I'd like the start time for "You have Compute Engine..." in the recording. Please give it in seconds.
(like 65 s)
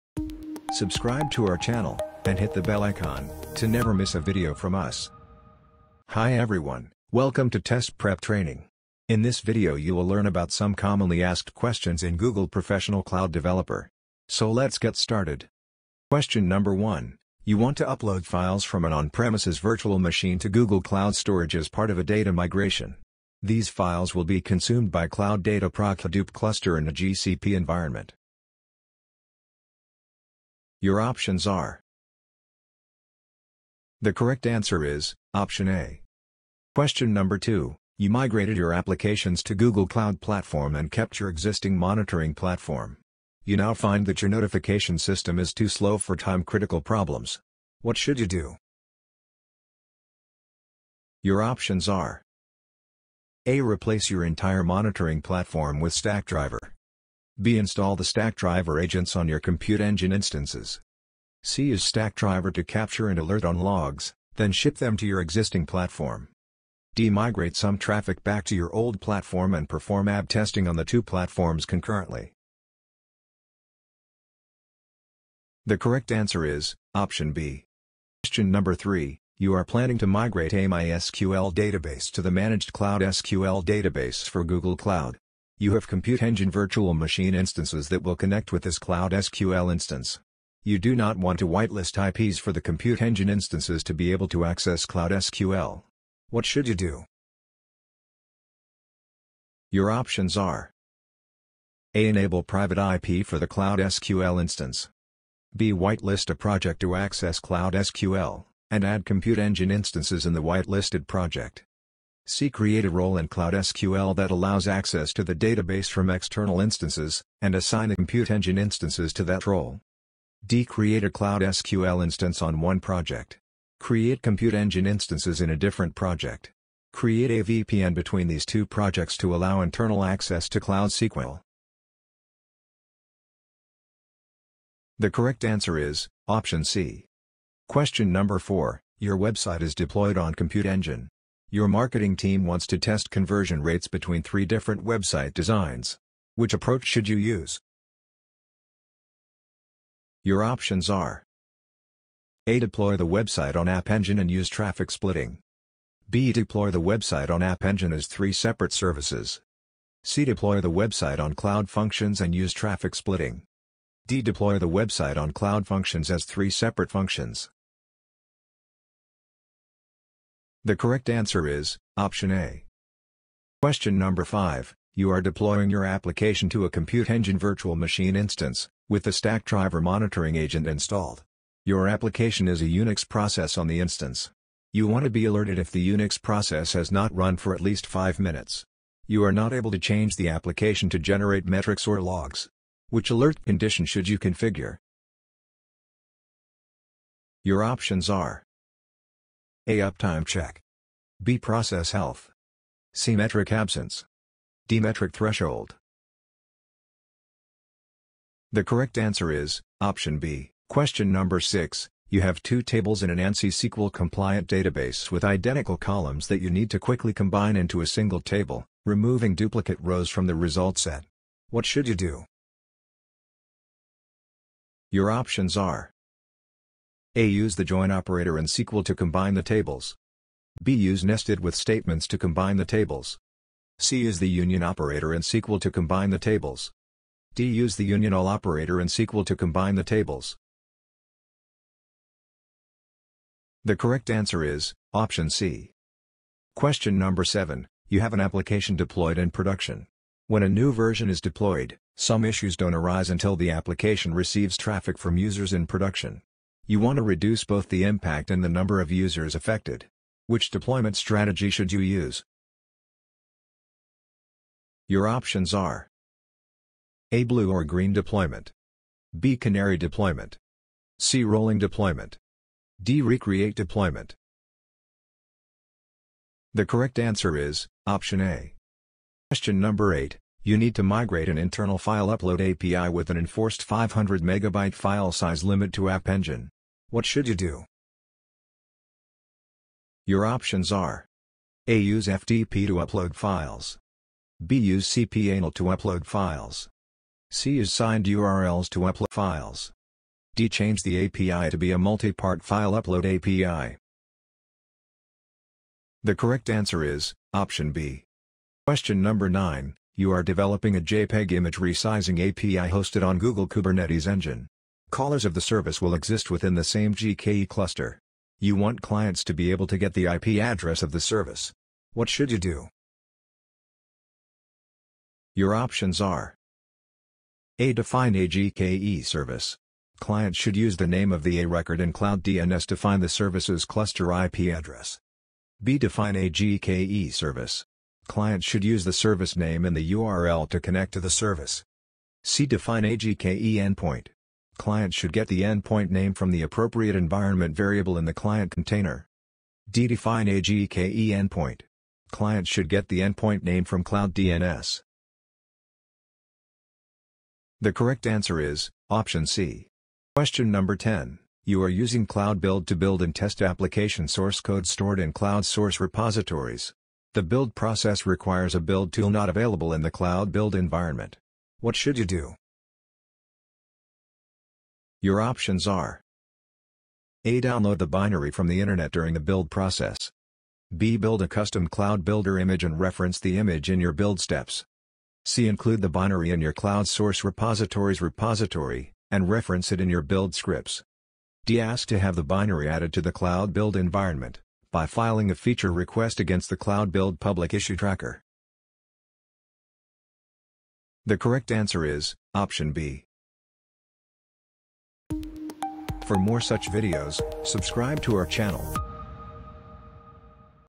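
85 s.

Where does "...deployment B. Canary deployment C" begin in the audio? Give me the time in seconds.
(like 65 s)
267 s.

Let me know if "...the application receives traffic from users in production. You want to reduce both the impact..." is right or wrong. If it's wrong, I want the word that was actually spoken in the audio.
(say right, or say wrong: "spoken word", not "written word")
right.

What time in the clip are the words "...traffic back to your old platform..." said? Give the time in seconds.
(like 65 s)
67 s.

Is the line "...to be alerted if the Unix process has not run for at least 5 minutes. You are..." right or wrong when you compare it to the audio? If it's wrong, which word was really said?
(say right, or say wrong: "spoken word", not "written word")
right.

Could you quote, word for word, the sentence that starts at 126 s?
Create a VPN between these two projects to allow internal access to Cloud SQL.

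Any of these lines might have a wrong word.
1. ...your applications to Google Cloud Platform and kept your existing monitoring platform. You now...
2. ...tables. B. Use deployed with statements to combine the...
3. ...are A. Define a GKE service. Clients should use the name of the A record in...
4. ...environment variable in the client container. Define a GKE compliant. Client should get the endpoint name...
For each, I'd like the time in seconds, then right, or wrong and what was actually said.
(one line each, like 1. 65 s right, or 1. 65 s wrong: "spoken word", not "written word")
1. 38 s right
2. 229 s wrong: "nested", not "deployed"
3. 326 s right
4. 346 s wrong: "endpoint", not "compliant".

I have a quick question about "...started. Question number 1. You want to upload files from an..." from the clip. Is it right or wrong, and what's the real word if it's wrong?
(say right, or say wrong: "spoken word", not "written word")
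right.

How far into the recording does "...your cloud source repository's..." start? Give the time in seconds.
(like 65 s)
386 s.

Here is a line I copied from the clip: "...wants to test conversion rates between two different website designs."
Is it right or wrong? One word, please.
wrong.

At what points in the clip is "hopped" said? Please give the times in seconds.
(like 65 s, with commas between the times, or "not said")
not said.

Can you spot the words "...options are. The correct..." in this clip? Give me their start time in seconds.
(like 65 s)
30 s.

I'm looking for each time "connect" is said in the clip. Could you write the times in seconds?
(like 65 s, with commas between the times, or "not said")
88 s, 340 s.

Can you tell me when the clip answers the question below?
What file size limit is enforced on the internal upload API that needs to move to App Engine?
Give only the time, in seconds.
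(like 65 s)
283 s.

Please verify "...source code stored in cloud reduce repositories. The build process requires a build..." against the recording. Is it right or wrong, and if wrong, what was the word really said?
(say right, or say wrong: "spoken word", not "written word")
wrong: "source", not "reduce".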